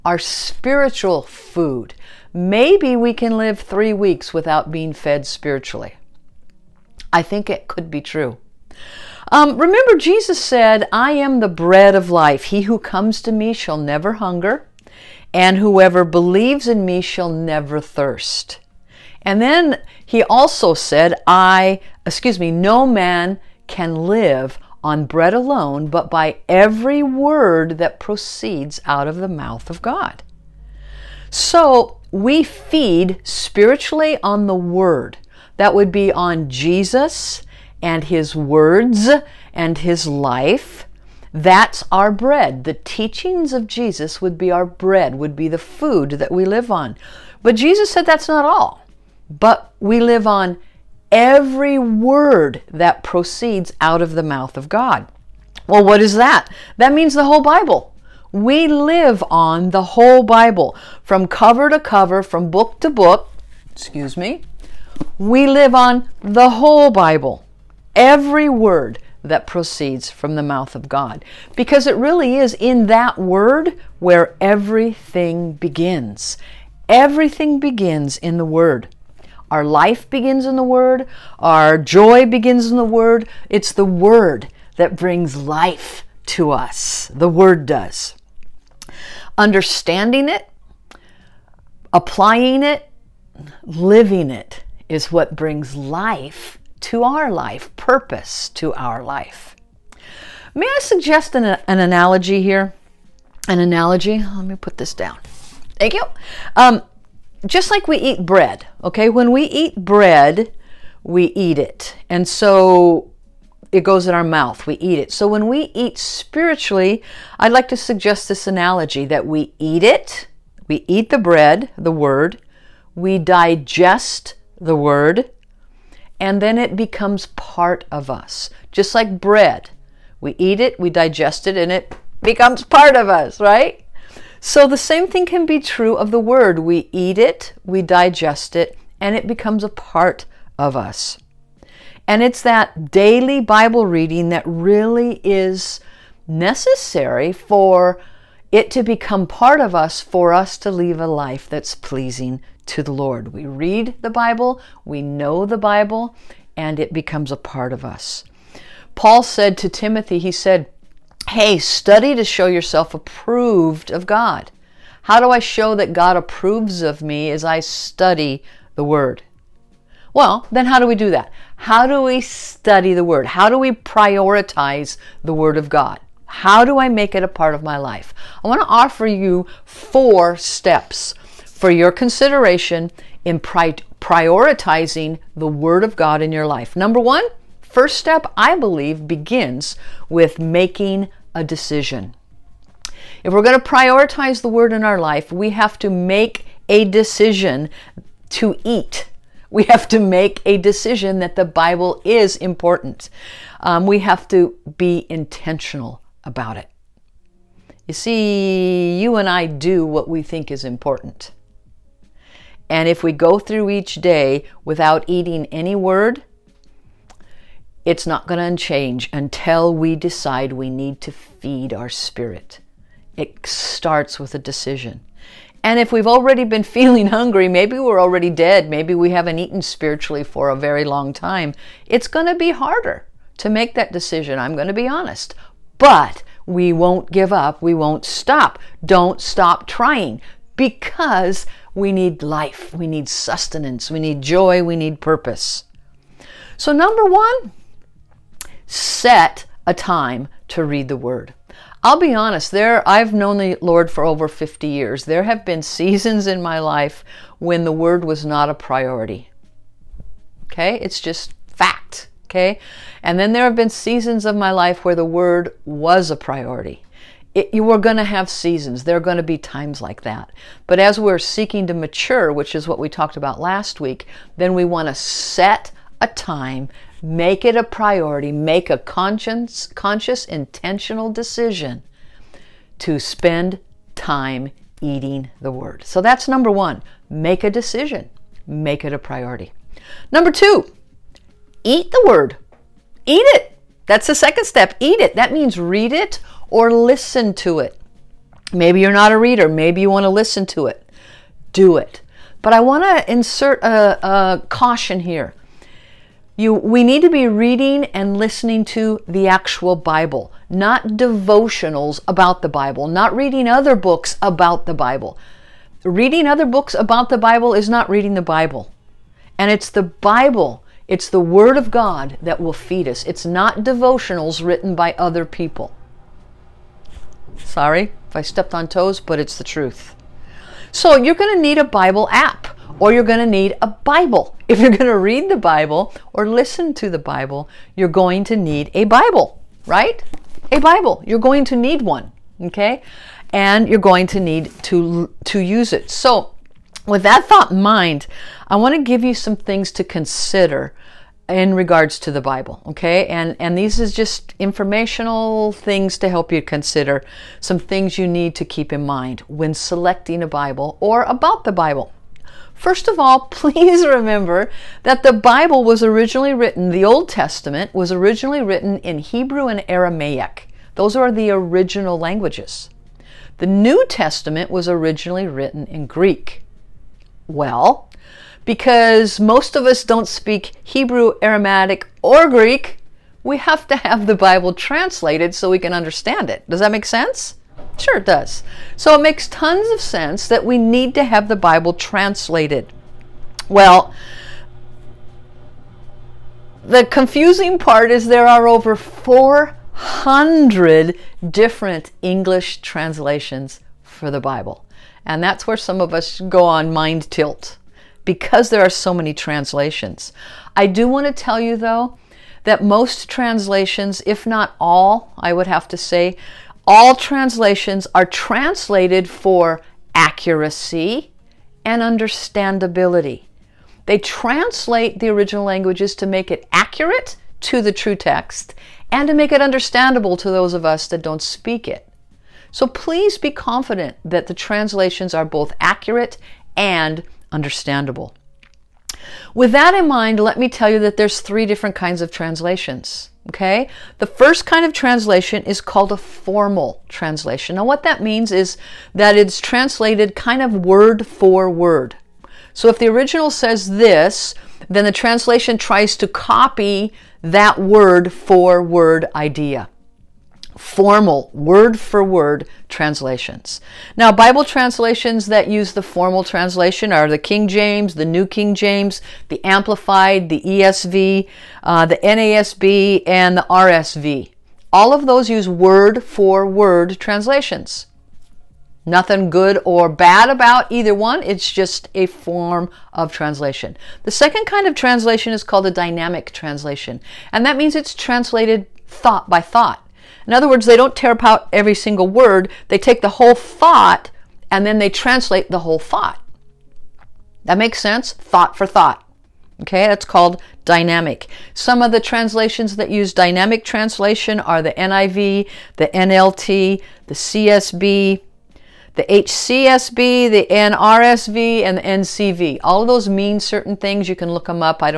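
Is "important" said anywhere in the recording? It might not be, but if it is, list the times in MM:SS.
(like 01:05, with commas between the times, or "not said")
03:22, 03:30.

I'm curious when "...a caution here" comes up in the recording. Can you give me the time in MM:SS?
05:04.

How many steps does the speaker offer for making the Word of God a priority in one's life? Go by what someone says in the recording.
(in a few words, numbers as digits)
4.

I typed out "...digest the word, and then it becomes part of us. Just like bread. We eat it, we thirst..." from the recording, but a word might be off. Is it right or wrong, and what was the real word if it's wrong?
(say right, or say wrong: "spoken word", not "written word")
wrong: "digest", not "thirst".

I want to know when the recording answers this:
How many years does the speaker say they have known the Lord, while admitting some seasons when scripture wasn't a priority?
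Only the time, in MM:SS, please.
04:14.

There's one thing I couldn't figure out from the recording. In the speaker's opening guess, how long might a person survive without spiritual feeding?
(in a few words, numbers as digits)
3 weeks.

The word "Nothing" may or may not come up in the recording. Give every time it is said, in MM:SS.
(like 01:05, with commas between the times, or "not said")
07:58.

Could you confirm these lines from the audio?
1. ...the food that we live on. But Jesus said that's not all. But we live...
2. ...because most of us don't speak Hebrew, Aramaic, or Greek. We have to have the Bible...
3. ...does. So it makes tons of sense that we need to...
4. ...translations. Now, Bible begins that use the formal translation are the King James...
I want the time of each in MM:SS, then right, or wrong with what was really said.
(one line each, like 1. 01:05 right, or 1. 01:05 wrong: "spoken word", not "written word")
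1. 00:45 right
2. 06:18 right
3. 06:28 right
4. 07:42 wrong: "translations", not "begins".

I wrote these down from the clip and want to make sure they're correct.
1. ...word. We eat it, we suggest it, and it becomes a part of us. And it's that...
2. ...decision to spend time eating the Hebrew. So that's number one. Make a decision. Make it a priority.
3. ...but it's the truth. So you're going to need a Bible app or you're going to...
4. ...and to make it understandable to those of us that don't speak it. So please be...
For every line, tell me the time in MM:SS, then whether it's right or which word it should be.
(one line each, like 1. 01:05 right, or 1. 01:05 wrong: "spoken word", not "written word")
1. 02:16 wrong: "digest", not "suggest"
2. 04:41 wrong: "Word", not "Hebrew"
3. 05:29 right
4. 07:08 right.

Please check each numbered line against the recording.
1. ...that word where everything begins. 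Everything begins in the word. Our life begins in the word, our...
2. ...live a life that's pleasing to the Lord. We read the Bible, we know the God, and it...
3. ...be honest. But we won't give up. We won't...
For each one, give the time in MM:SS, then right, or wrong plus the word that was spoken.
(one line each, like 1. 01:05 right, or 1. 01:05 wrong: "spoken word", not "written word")
1. 01:12 right
2. 02:30 wrong: "Bible", not "God"
3. 03:54 right.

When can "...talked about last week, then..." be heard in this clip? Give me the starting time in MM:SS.
04:32.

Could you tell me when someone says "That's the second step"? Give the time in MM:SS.
04:53.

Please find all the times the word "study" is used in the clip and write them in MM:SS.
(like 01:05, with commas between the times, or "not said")
02:41, 02:47, 02:52.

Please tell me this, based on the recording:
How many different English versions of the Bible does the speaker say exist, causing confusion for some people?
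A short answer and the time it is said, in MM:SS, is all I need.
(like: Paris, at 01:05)
over 400, at 06:38.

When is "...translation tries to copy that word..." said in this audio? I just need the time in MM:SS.
07:34.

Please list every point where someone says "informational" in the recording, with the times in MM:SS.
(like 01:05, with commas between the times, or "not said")
05:54.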